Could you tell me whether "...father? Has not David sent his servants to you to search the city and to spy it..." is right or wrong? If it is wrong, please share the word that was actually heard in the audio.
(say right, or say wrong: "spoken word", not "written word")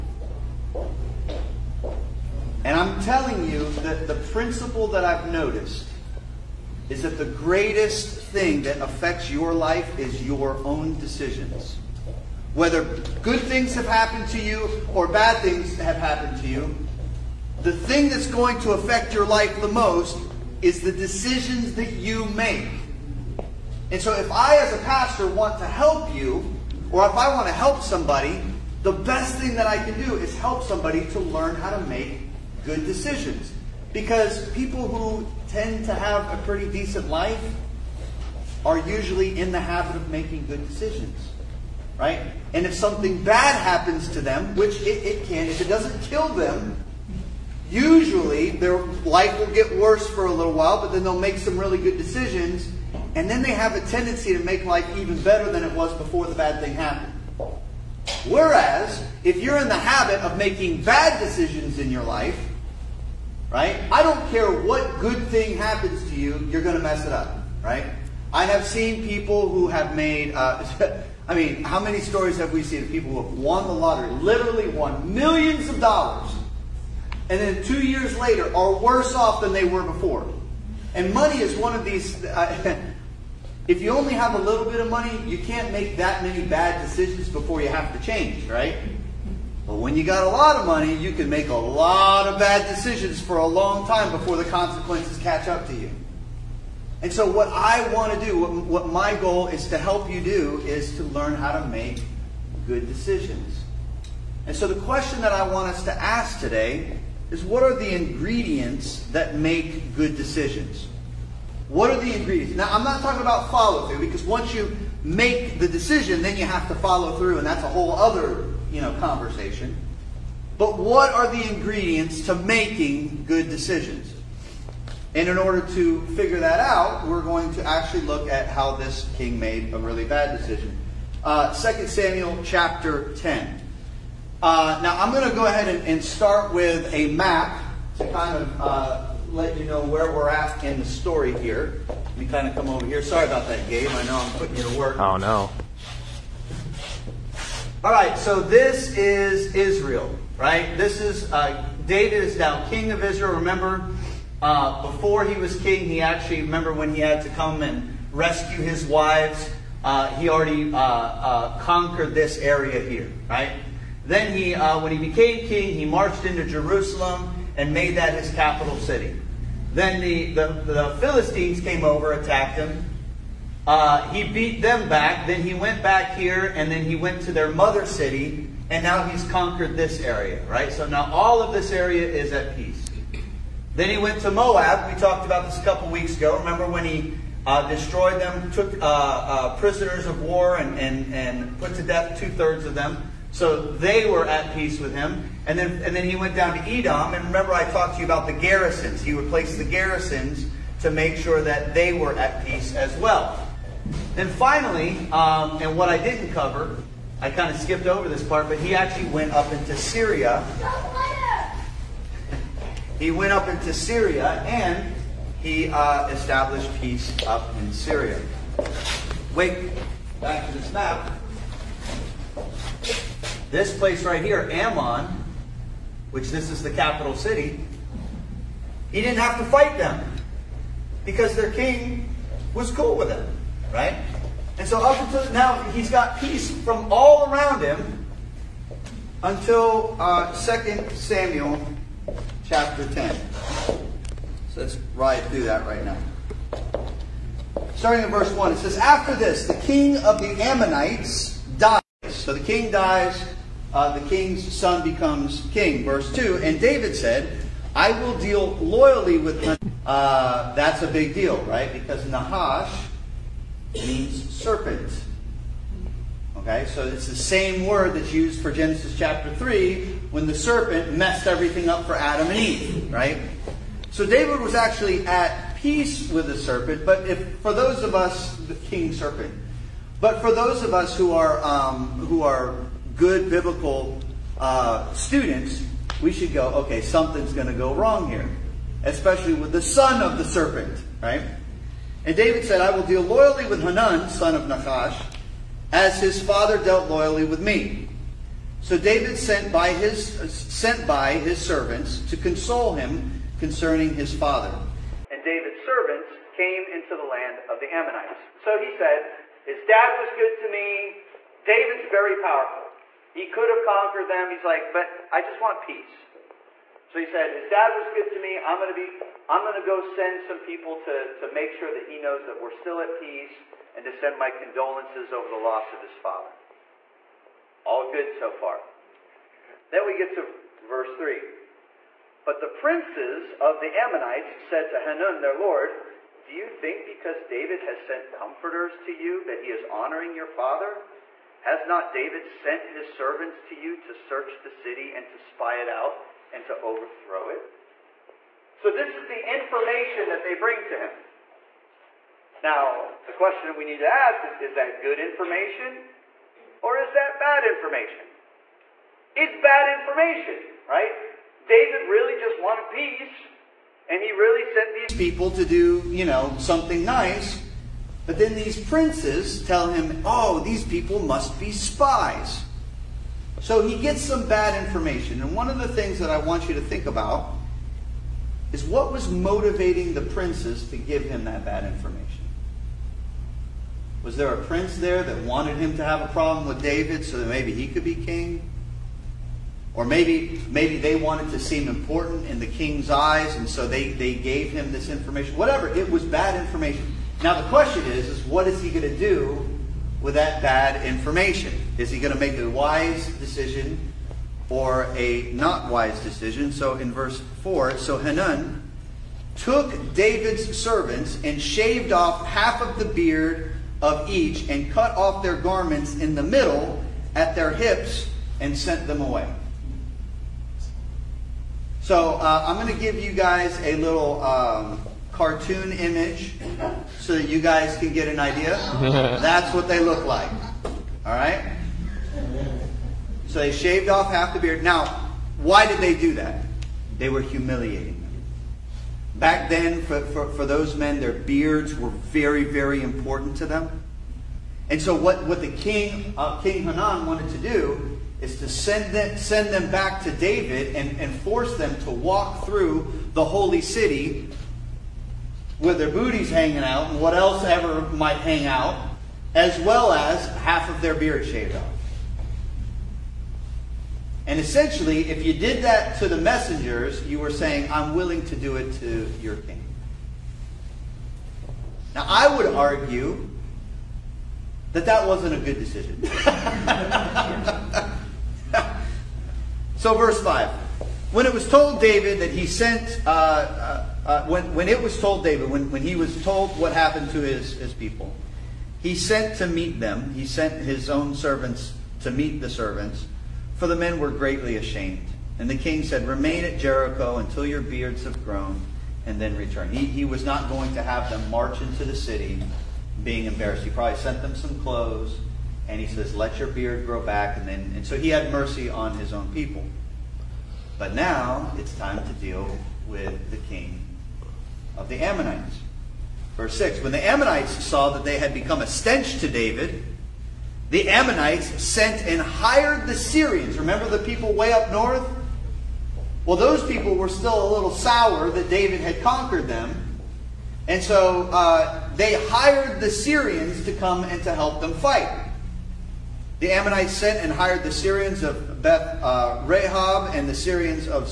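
right.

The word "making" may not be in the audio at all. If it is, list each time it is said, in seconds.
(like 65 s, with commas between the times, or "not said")
40 s, 60 s, 122 s.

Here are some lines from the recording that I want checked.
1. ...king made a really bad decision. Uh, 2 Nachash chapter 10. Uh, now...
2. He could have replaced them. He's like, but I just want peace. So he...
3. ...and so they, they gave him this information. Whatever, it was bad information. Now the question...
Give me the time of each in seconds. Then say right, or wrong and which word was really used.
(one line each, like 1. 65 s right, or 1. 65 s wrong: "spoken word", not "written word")
1. 129 s wrong: "Samuel", not "Nachash"
2. 313 s wrong: "conquered", not "replaced"
3. 393 s right.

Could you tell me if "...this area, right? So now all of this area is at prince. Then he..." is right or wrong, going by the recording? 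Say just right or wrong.
wrong.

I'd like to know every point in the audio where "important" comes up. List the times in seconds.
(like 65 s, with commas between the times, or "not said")
391 s, 442 s.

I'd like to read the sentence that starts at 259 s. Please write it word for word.
Uh, that's a big deal, right?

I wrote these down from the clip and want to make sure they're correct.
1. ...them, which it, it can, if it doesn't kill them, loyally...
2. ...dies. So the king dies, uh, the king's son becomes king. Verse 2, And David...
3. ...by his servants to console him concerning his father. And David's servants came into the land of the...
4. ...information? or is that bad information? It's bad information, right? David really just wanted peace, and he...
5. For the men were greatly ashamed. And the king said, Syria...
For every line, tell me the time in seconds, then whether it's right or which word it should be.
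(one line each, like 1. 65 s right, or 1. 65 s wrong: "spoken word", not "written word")
1. 44 s wrong: "usually", not "loyally"
2. 251 s right
3. 300 s right
4. 354 s right
5. 493 s wrong: "Remain", not "Syria".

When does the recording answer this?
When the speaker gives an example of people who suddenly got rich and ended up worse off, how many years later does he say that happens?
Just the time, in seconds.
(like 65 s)
77 s.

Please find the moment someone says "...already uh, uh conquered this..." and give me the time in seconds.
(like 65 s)
160 s.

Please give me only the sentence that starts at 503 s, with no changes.
He probably sent them some clothes, and he says, Let your beard grow back.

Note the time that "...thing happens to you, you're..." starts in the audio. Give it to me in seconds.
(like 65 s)
65 s.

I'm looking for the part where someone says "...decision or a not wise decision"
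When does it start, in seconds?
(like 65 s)
403 s.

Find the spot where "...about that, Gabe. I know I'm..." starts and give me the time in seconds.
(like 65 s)
143 s.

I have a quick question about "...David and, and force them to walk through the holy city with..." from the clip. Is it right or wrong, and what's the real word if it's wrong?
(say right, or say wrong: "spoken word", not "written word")
right.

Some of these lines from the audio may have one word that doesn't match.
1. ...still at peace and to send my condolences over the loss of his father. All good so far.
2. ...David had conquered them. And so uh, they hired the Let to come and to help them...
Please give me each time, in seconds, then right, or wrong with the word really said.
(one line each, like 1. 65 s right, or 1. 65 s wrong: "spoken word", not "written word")
1. 322 s right
2. 528 s wrong: "Syrians", not "Let".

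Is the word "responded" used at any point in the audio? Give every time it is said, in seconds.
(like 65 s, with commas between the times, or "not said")
not said.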